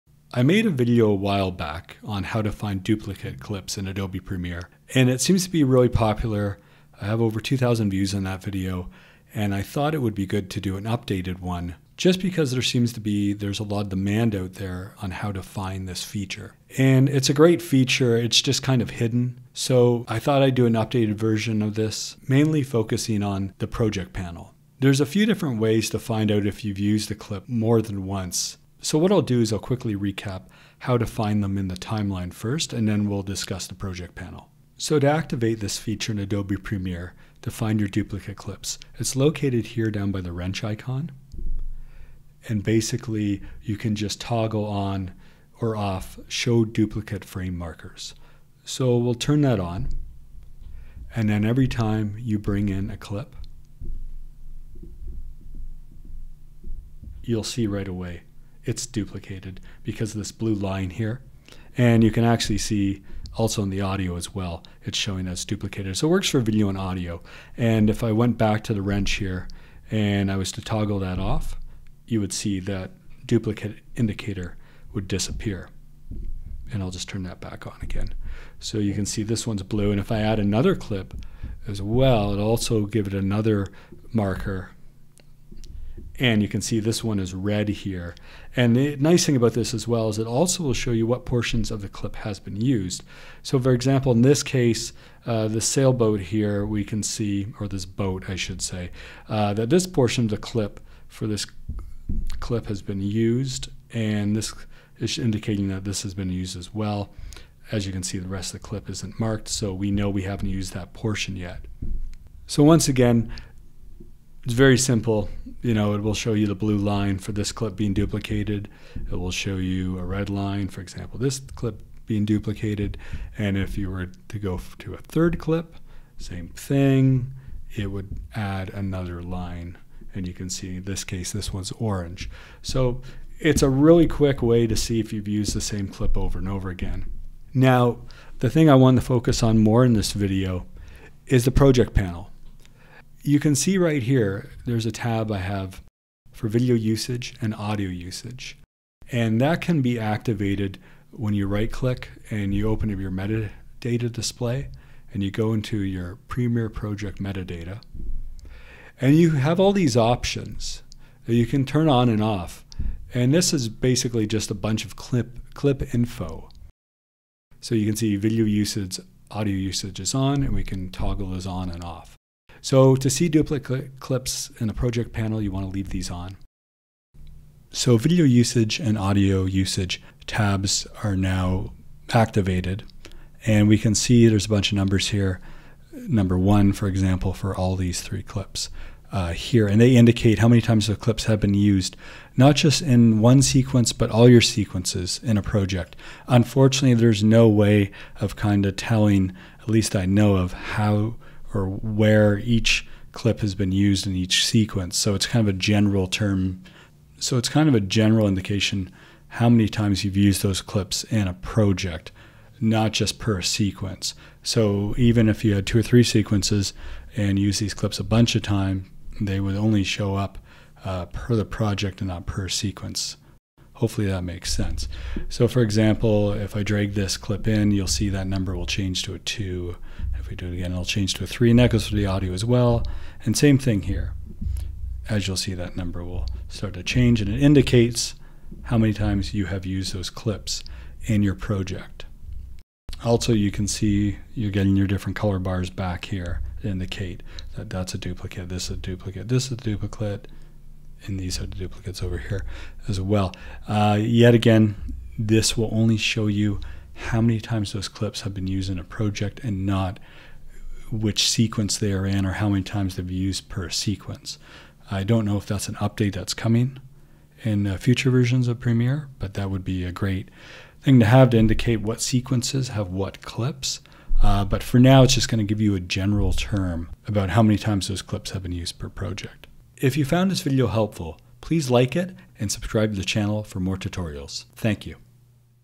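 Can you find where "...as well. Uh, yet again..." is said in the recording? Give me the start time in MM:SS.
04:12.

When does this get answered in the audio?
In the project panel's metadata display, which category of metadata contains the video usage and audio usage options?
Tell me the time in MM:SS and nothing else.
02:36.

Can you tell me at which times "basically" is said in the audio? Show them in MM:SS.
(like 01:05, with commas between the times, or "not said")
00:42, 02:43.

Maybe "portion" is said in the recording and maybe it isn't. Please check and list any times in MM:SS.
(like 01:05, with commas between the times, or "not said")
01:31, 01:39, 01:50.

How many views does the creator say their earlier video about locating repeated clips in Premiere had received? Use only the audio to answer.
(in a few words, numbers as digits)
over 2,000.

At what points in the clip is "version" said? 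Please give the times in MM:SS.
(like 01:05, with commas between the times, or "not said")
00:21, 04:28.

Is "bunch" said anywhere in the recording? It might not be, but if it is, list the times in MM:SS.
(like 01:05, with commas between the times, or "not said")
02:44, 03:04, 03:38.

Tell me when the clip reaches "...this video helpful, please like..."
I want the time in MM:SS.
04:40.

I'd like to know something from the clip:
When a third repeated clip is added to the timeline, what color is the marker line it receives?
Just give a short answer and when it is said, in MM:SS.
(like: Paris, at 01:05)
orange, at 02:11.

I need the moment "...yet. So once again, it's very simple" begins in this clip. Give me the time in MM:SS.
01:51.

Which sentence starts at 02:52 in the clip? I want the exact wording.
So to see duplicate clips in the project panel, you want to leave these on.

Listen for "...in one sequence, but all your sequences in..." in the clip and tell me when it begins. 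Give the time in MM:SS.
03:12.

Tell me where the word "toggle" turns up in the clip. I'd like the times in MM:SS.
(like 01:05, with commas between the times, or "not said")
00:44, 01:10, 02:50.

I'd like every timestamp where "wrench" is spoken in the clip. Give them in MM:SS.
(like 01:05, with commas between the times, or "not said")
00:40, 01:08.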